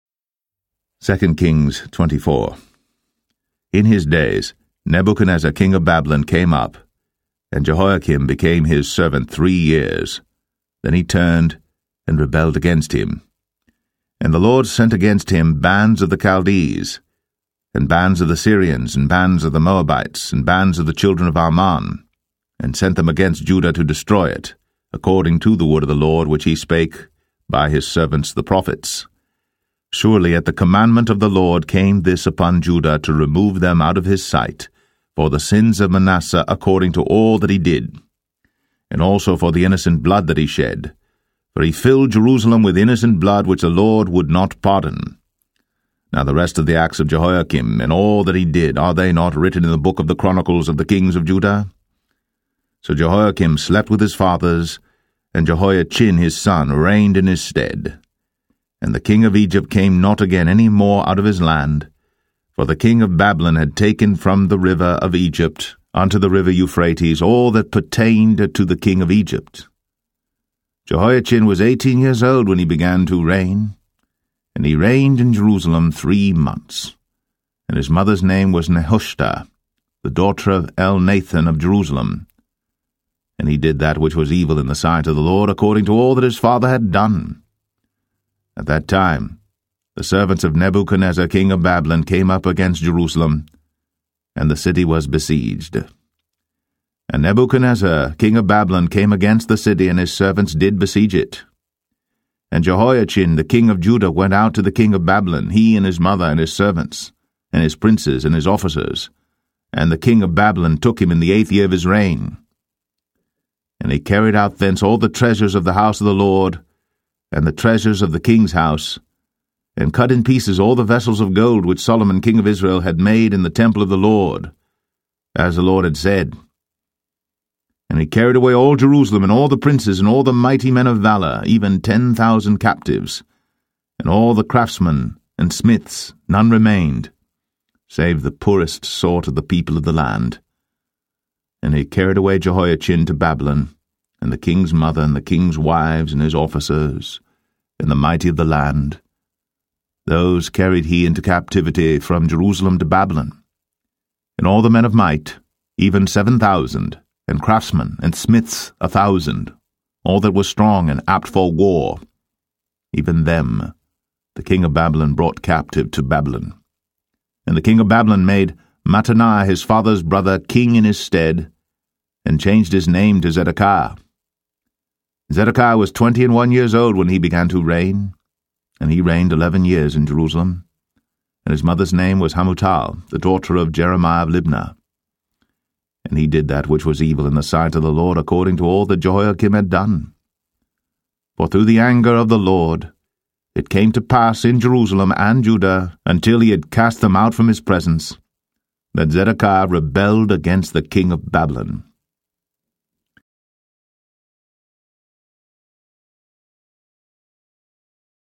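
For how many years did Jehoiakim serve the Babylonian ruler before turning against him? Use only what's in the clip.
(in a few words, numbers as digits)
3 years.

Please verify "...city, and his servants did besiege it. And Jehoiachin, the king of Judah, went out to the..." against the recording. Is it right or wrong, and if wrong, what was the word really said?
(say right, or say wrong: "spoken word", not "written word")
right.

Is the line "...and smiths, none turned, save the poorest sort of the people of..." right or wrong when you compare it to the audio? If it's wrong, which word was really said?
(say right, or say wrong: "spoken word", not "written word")
wrong: "remained", not "turned".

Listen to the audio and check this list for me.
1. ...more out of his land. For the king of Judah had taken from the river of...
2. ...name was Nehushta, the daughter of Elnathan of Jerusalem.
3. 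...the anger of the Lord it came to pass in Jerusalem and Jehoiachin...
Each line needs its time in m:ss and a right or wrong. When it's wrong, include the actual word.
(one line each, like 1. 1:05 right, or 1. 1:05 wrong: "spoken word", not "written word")
1. 1:00 wrong: "Babylon", not "Judah"
2. 1:18 right
3. 3:11 wrong: "Judah", not "Jehoiachin".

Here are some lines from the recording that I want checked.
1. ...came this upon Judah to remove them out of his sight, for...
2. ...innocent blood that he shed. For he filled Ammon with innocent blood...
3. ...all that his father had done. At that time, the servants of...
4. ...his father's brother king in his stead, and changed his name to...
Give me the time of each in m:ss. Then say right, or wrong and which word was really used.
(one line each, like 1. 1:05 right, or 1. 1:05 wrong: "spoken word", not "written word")
1. 0:31 right
2. 0:39 wrong: "Jerusalem", not "Ammon"
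3. 1:25 right
4. 2:49 right.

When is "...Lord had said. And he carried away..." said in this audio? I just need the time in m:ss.
2:05.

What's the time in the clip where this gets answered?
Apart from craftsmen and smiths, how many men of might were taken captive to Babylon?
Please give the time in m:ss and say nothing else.
2:36.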